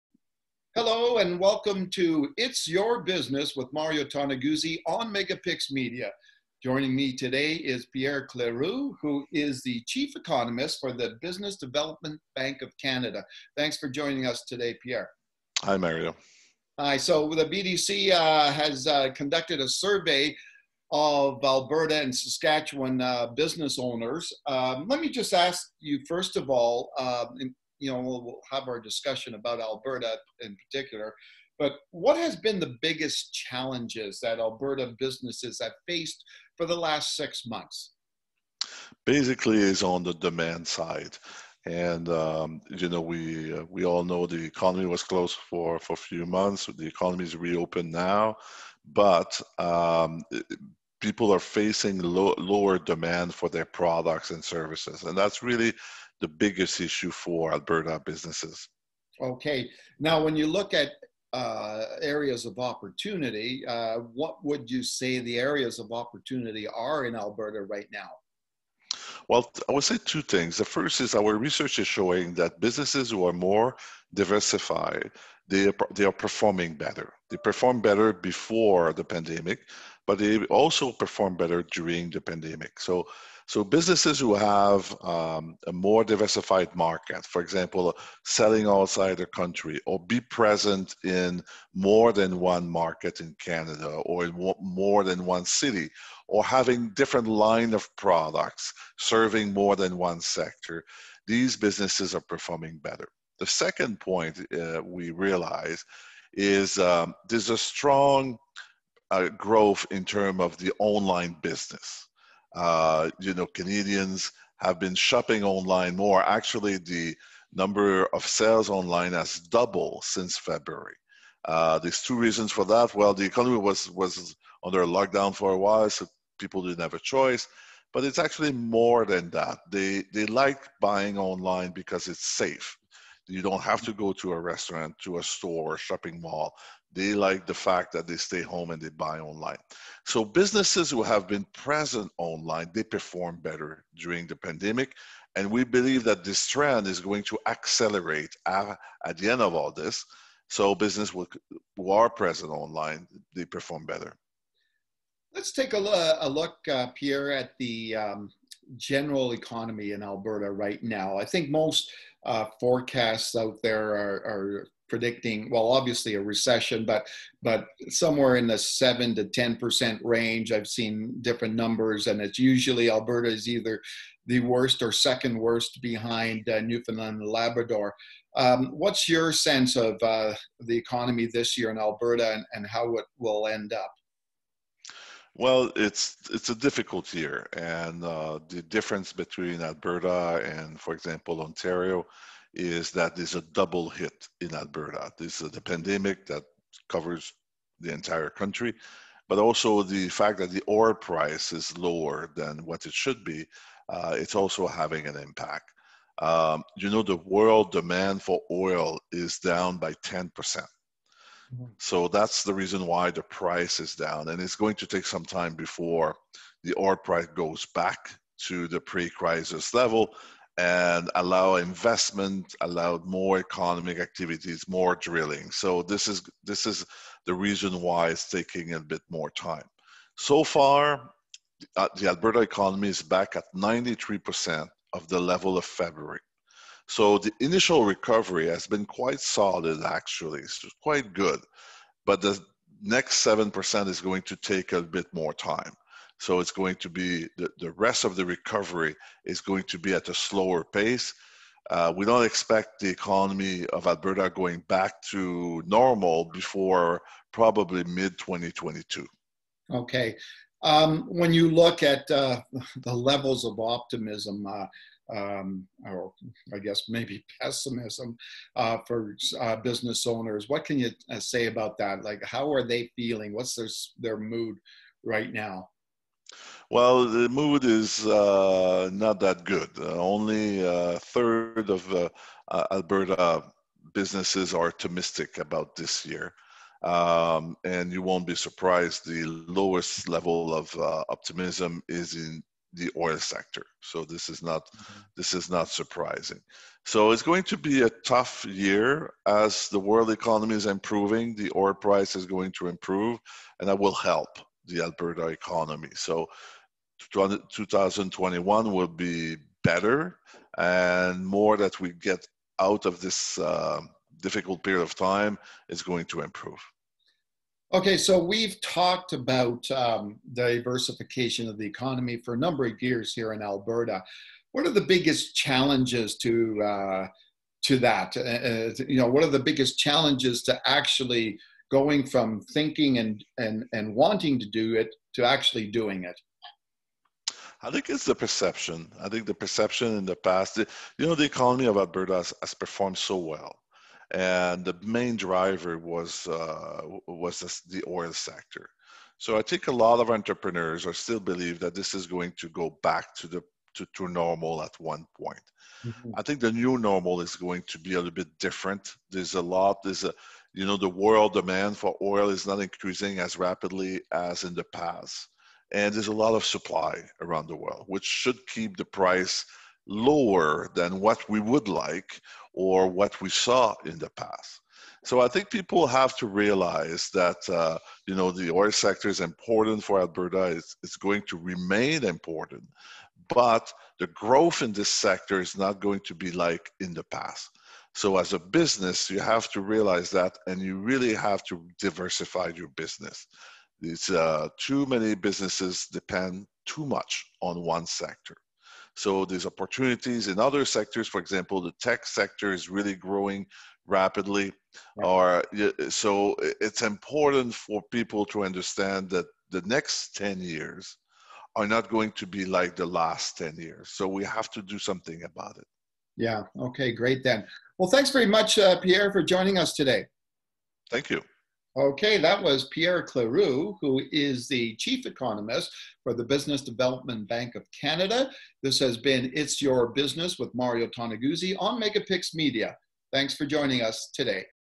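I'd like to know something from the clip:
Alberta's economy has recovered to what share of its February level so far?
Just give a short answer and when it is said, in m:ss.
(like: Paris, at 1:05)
93%, at 3:53.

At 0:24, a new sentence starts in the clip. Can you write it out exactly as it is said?
Um, let me just ask you, first of all, um, in, you know, we'll, have our discussion about Alberta in particular.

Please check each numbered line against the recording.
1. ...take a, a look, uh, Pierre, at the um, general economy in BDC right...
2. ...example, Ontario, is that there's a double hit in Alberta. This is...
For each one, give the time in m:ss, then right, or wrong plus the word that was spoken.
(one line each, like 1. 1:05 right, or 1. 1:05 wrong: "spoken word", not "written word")
1. 2:35 wrong: "Alberta", not "BDC"
2. 3:10 right.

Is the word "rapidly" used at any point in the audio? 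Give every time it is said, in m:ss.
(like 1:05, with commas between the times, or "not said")
6:03, 6:43.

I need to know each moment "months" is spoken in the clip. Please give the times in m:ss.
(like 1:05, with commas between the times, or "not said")
0:37, 0:46.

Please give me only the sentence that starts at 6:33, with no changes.
It's uh, too many businesses depend too much on one sector.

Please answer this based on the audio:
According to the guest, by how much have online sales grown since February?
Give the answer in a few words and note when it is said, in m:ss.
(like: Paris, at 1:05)
doubled, at 1:59.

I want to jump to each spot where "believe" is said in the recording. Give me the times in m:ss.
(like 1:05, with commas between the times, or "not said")
2:25, 5:51.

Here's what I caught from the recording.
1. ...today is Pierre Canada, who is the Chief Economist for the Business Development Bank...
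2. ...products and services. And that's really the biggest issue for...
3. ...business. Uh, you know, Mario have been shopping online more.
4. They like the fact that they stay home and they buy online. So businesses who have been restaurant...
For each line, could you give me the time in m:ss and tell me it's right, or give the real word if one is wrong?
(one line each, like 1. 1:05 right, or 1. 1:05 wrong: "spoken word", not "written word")
1. 0:07 wrong: "Cléroux", not "Canada"
2. 0:53 right
3. 1:51 wrong: "Canadians", not "Mario"
4. 2:16 wrong: "present", not "restaurant".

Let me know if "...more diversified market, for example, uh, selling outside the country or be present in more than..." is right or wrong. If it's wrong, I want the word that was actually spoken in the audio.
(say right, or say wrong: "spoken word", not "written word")
right.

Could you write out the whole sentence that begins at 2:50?
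I've seen different numbers, and it's usually Alberta is either the worst or second worst behind uh, Newfoundland and Labrador.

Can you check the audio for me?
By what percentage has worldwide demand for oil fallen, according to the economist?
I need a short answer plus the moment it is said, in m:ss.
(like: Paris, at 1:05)
10%, at 3:30.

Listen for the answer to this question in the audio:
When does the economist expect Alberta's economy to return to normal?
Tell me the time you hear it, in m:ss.
4:17.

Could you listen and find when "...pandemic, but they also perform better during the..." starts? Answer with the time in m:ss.
1:19.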